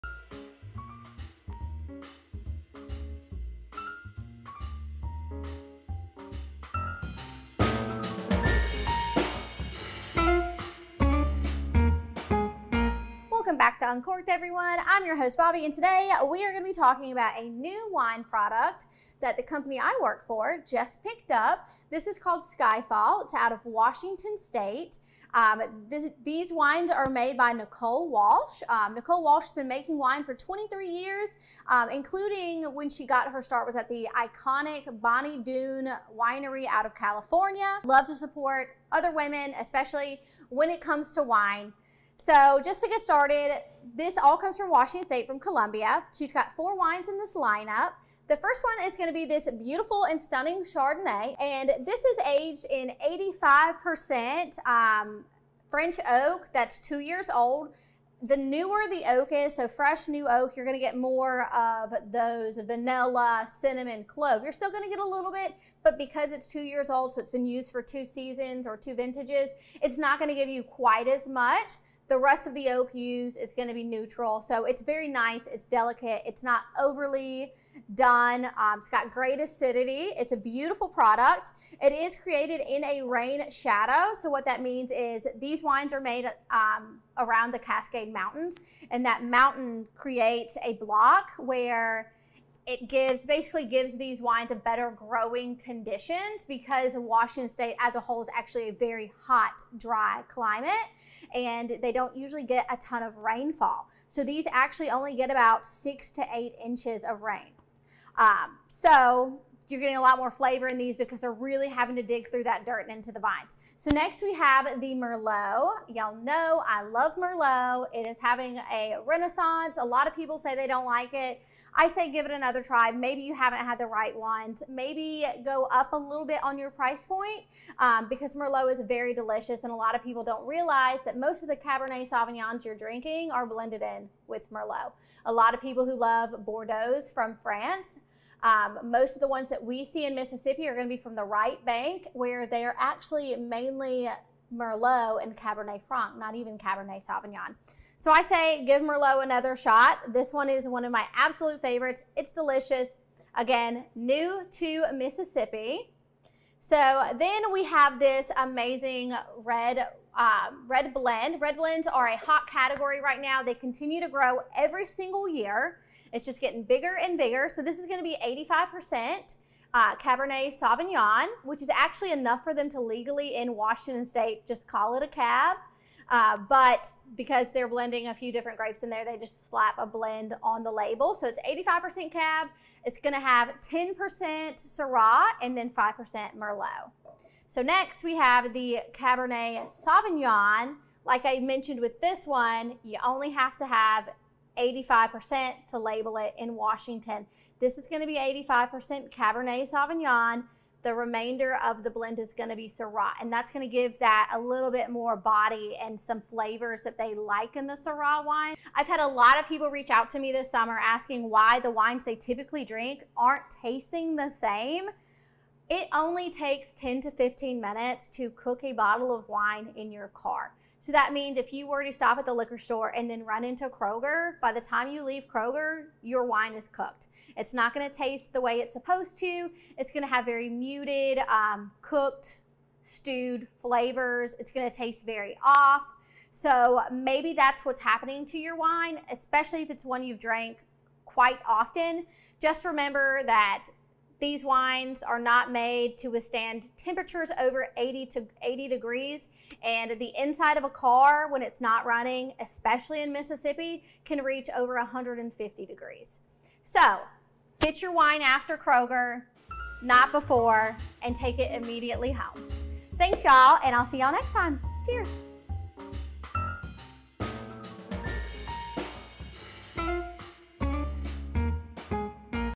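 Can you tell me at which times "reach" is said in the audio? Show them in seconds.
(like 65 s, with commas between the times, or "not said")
209 s, 254 s.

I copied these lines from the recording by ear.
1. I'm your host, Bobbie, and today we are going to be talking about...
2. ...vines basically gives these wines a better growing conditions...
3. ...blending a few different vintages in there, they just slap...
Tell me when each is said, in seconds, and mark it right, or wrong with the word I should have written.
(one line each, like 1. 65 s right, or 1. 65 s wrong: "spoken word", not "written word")
1. 14 s right
2. 92 s wrong: "gives", not "vines"
3. 177 s wrong: "grapes", not "vintages".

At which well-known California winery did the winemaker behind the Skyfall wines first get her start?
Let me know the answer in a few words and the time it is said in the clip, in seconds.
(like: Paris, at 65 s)
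Bonny Doon, at 35 s.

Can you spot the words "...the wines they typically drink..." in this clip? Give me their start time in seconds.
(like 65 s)
211 s.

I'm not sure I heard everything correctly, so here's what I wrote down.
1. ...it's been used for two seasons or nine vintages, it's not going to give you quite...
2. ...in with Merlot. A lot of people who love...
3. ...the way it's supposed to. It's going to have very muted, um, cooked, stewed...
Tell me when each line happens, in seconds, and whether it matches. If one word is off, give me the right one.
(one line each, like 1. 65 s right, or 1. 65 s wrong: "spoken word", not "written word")
1. 67 s wrong: "two", not "nine"
2. 133 s right
3. 228 s right.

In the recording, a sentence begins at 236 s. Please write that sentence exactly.
So maybe that's what's happening to your wine, especially if it's one you've drank quite often.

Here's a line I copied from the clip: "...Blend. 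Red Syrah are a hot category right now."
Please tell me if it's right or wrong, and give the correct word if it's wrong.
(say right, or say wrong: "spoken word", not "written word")
wrong: "Blends", not "Syrah".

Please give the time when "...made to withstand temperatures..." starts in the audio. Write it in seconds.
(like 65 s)
245 s.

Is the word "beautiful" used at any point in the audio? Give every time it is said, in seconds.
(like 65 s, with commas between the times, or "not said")
49 s, 80 s.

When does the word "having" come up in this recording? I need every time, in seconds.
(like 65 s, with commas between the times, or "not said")
111 s, 118 s.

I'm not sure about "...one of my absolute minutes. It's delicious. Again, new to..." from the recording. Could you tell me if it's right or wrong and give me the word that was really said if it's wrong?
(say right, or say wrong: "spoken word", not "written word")
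wrong: "favorites", not "minutes".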